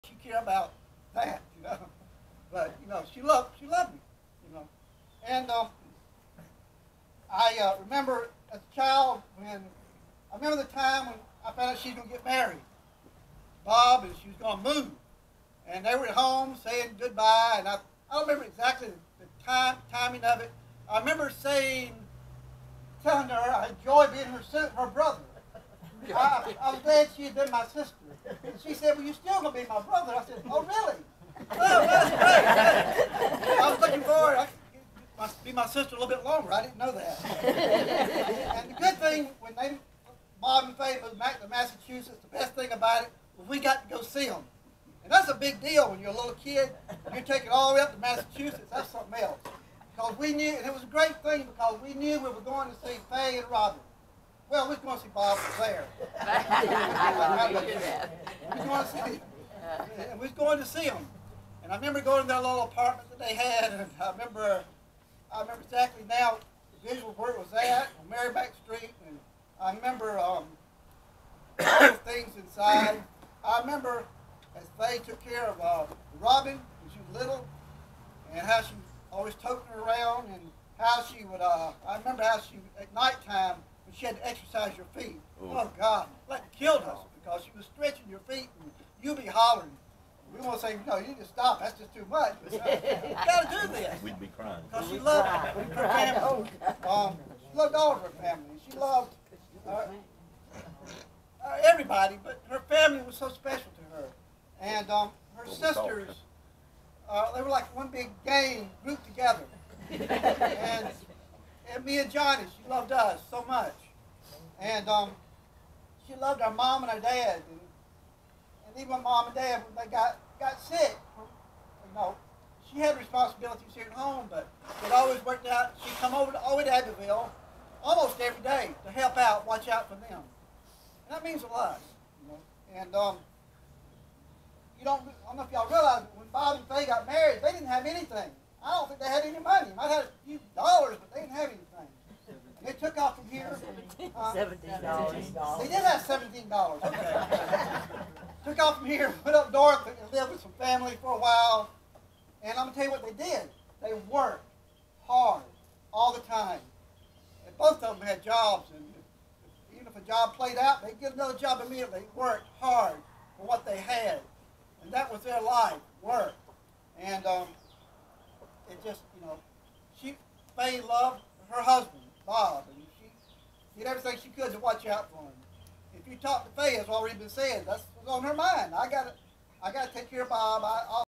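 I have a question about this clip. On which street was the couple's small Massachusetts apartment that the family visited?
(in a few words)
Maryback Street.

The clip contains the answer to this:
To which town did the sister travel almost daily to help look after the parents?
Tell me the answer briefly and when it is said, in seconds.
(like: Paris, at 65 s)
Abbeville, at 126 s.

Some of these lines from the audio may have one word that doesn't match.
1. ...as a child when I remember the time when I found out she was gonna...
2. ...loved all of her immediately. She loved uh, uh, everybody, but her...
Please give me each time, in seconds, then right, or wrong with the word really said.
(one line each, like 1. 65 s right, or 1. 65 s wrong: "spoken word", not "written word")
1. 8 s right
2. 97 s wrong: "family", not "immediately".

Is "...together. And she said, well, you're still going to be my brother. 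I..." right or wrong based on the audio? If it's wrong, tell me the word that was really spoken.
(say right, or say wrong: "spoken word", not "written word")
wrong: "sister", not "together".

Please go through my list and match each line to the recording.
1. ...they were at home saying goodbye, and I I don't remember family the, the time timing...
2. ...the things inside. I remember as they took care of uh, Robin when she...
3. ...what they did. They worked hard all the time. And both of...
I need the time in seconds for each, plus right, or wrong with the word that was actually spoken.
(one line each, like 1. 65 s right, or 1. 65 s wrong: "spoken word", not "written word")
1. 15 s wrong: "exactly", not "family"
2. 71 s right
3. 152 s right.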